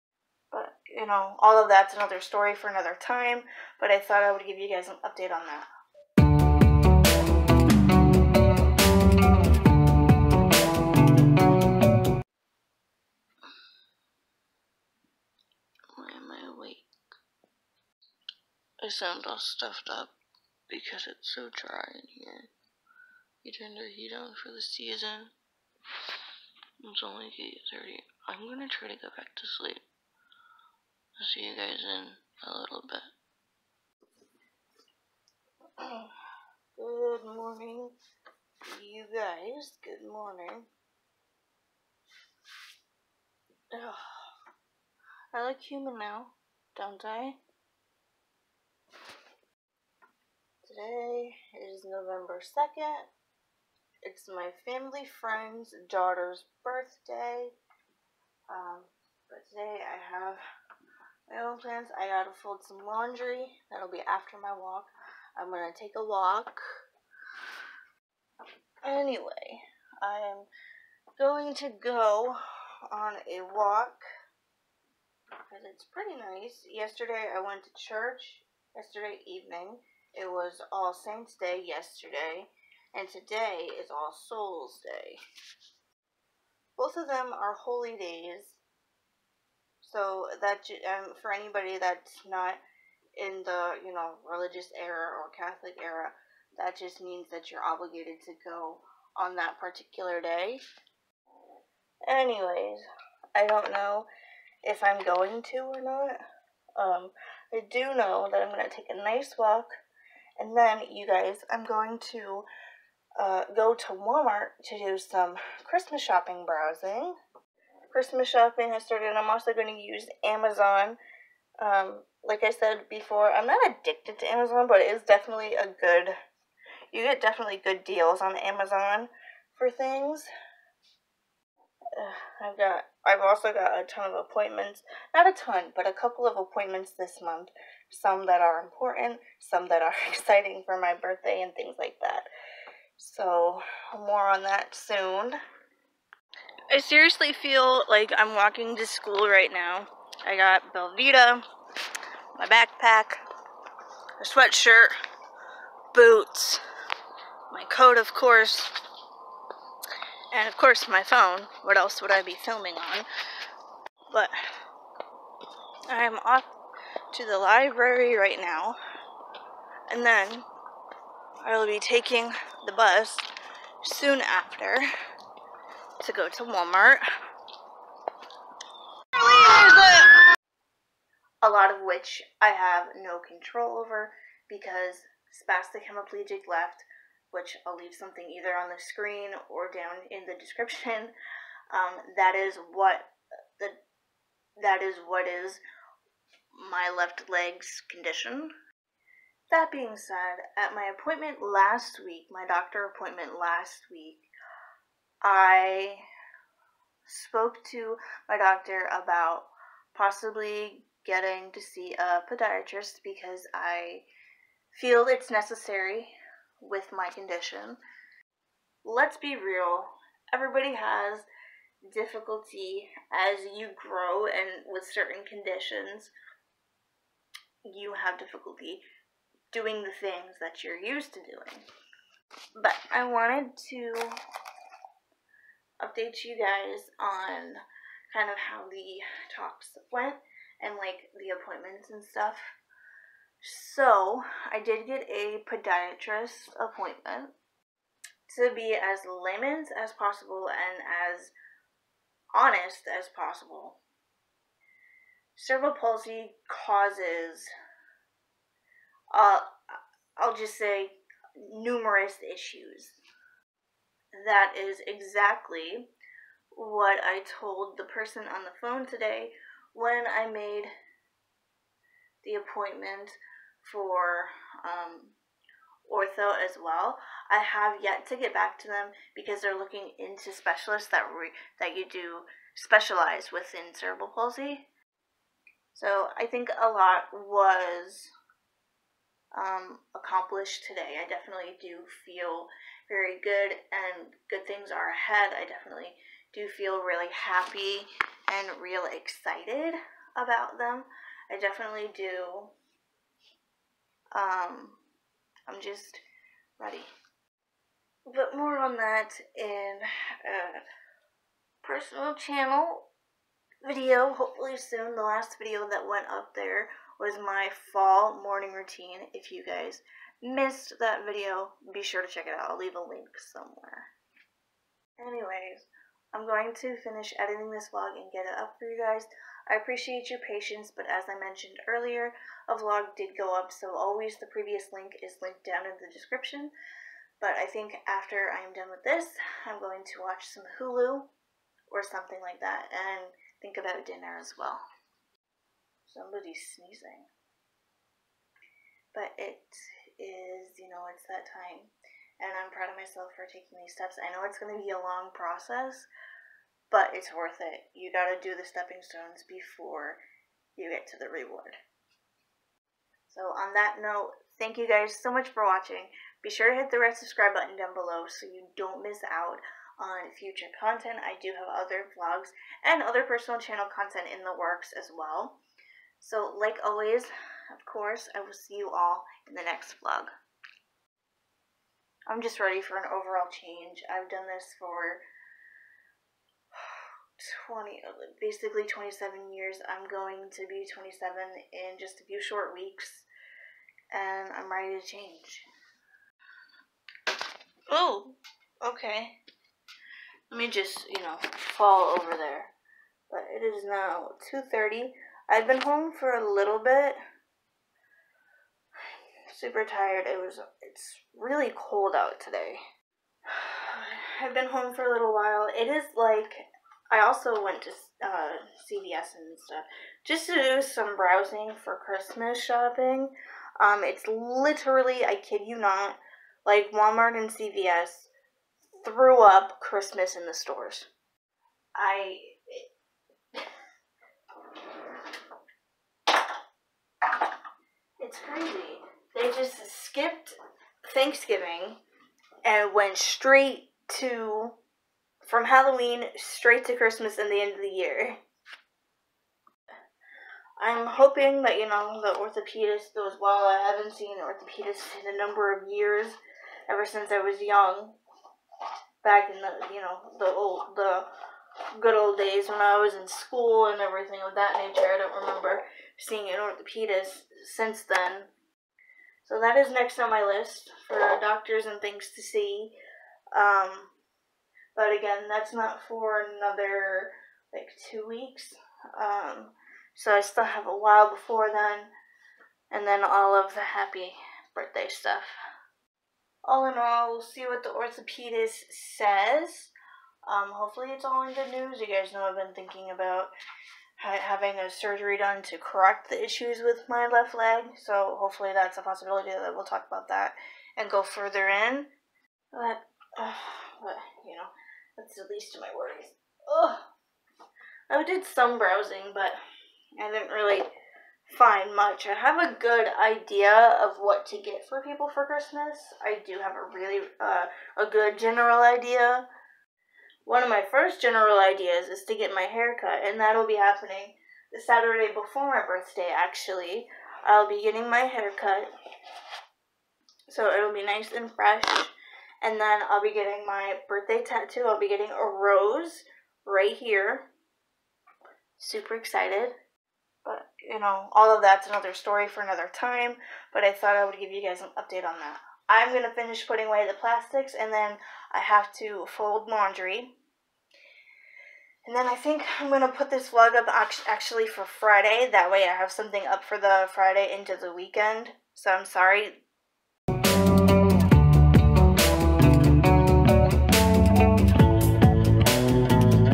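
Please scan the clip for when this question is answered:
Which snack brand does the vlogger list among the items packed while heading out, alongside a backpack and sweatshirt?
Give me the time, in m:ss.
2:30.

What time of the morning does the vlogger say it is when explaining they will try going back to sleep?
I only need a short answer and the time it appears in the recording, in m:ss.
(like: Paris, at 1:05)
8:30, at 0:27.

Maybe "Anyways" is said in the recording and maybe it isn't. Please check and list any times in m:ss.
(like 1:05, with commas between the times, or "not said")
1:08, 1:42, 5:25.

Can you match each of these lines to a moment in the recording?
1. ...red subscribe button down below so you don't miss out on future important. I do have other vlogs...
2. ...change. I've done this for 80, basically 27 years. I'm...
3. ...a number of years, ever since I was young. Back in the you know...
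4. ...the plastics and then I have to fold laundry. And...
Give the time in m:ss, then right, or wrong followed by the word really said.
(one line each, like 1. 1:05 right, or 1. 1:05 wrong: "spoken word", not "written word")
1. 6:06 wrong: "content", not "important"
2. 6:23 wrong: "20", not "80"
3. 7:35 right
4. 9:06 right.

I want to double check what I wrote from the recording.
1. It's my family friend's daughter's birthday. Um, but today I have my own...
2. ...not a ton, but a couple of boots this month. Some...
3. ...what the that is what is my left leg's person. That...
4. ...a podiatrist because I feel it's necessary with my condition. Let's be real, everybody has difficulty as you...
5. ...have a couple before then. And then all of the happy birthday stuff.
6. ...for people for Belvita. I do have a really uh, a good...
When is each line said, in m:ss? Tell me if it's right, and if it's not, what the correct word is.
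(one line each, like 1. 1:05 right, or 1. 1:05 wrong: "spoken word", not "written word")
1. 0:54 right
2. 2:15 wrong: "appointments", not "boots"
3. 3:12 wrong: "condition", not "person"
4. 3:31 right
5. 8:00 wrong: "while", not "couple"
6. 8:34 wrong: "Christmas", not "Belvita".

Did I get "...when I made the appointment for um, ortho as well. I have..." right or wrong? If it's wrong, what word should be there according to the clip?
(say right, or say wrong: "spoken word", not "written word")
right.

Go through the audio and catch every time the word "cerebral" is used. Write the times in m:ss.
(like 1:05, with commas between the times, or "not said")
4:15, 4:43.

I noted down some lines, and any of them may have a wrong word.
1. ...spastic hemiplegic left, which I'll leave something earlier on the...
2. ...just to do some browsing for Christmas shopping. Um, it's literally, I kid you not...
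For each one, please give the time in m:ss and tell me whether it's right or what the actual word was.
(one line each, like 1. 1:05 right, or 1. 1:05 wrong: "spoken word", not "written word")
1. 3:05 wrong: "either", not "earlier"
2. 7:00 right.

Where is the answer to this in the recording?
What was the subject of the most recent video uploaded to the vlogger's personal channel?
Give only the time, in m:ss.
5:17.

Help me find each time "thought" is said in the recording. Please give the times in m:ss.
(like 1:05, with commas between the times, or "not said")
0:03, 9:03.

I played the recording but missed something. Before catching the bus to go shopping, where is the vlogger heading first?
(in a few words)
The library.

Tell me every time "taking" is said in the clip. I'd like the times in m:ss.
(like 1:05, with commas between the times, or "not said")
2:51, 5:53.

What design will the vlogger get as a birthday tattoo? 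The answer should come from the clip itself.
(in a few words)
A rose.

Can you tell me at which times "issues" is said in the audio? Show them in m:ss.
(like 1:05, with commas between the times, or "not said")
4:22, 8:16.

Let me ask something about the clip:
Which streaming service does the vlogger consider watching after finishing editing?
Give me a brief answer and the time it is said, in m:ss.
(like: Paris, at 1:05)
Hulu, at 5:40.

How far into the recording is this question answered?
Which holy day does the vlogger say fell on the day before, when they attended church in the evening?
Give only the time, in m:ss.
1:20.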